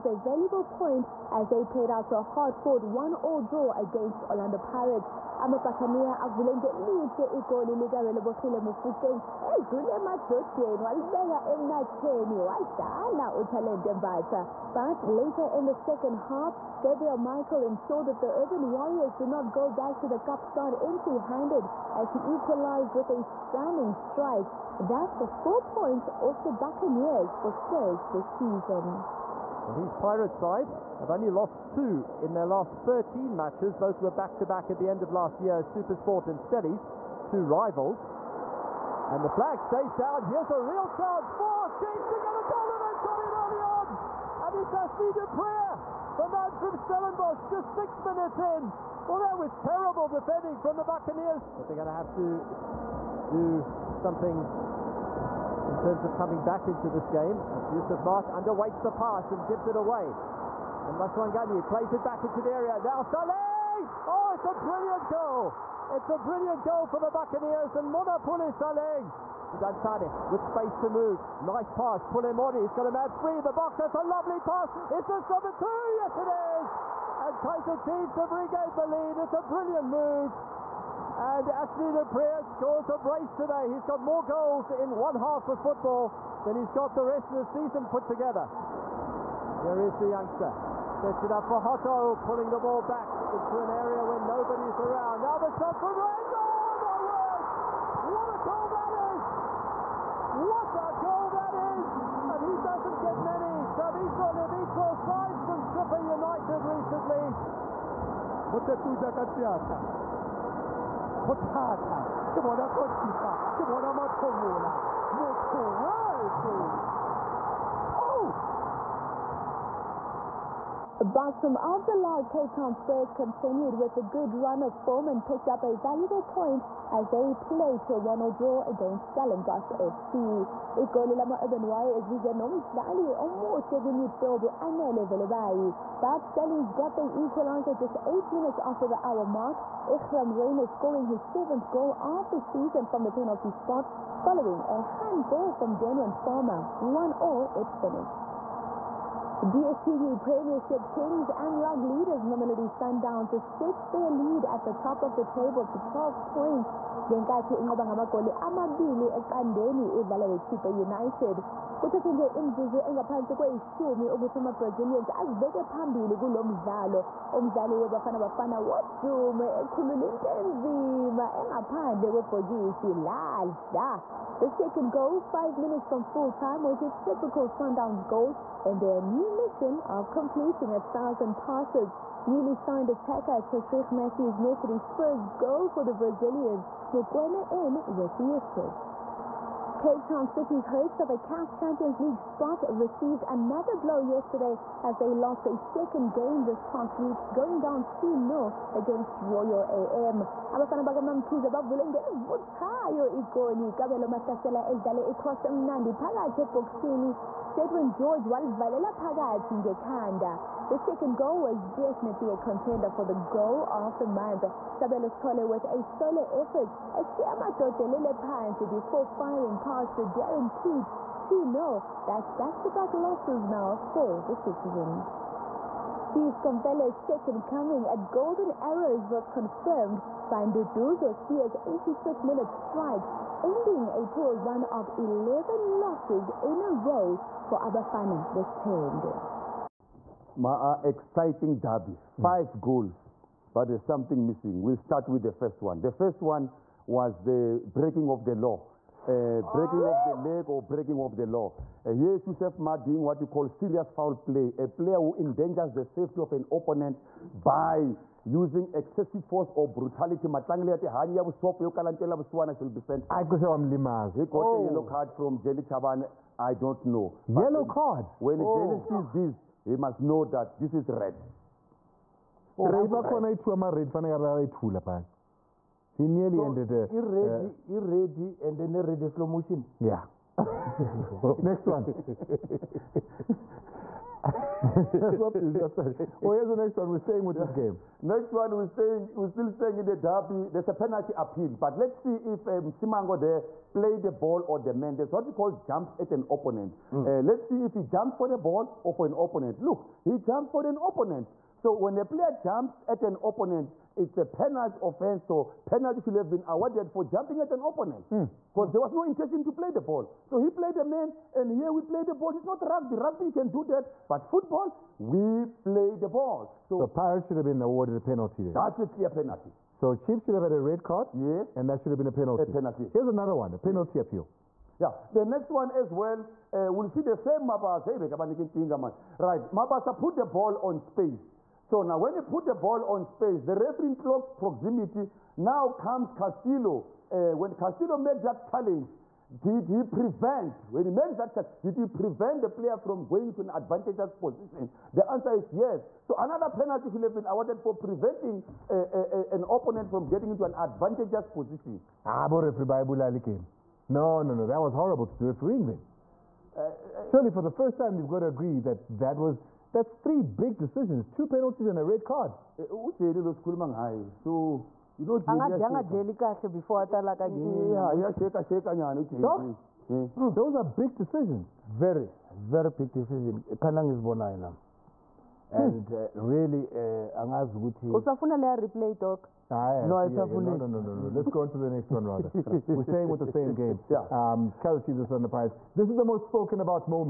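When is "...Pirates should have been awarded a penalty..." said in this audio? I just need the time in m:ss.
5:16.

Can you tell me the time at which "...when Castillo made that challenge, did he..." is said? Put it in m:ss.
5:37.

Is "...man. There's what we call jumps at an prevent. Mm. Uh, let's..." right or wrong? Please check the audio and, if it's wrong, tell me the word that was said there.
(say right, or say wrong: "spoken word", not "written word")
wrong: "opponent", not "prevent".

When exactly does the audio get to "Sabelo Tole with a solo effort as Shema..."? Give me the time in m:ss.
3:34.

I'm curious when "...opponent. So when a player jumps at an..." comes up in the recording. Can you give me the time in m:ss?
5:00.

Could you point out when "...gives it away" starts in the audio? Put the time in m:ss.
0:59.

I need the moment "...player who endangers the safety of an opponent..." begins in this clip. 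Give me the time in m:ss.
4:14.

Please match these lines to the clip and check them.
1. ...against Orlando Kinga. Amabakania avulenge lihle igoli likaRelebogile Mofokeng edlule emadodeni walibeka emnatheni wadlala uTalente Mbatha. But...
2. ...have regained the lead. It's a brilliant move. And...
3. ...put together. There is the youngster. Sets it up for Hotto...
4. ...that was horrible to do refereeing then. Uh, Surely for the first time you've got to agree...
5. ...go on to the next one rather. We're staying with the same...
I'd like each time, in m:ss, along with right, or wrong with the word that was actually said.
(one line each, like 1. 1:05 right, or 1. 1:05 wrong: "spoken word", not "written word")
1. 0:03 wrong: "Pirates", not "Kinga"
2. 1:18 right
3. 1:27 right
4. 5:54 right
5. 6:21 right.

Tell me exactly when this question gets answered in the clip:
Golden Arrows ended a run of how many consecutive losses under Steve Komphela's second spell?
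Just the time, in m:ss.
3:54.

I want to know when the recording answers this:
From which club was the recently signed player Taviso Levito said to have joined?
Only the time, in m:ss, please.
1:45.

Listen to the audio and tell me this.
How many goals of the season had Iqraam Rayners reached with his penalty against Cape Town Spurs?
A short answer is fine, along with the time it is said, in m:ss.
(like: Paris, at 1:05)
7, at 2:21.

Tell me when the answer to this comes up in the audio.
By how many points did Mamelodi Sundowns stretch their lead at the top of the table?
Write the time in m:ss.
2:35.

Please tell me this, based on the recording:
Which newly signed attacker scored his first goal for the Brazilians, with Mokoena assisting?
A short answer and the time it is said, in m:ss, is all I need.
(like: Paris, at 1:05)
Tashreeq Matthews, at 3:03.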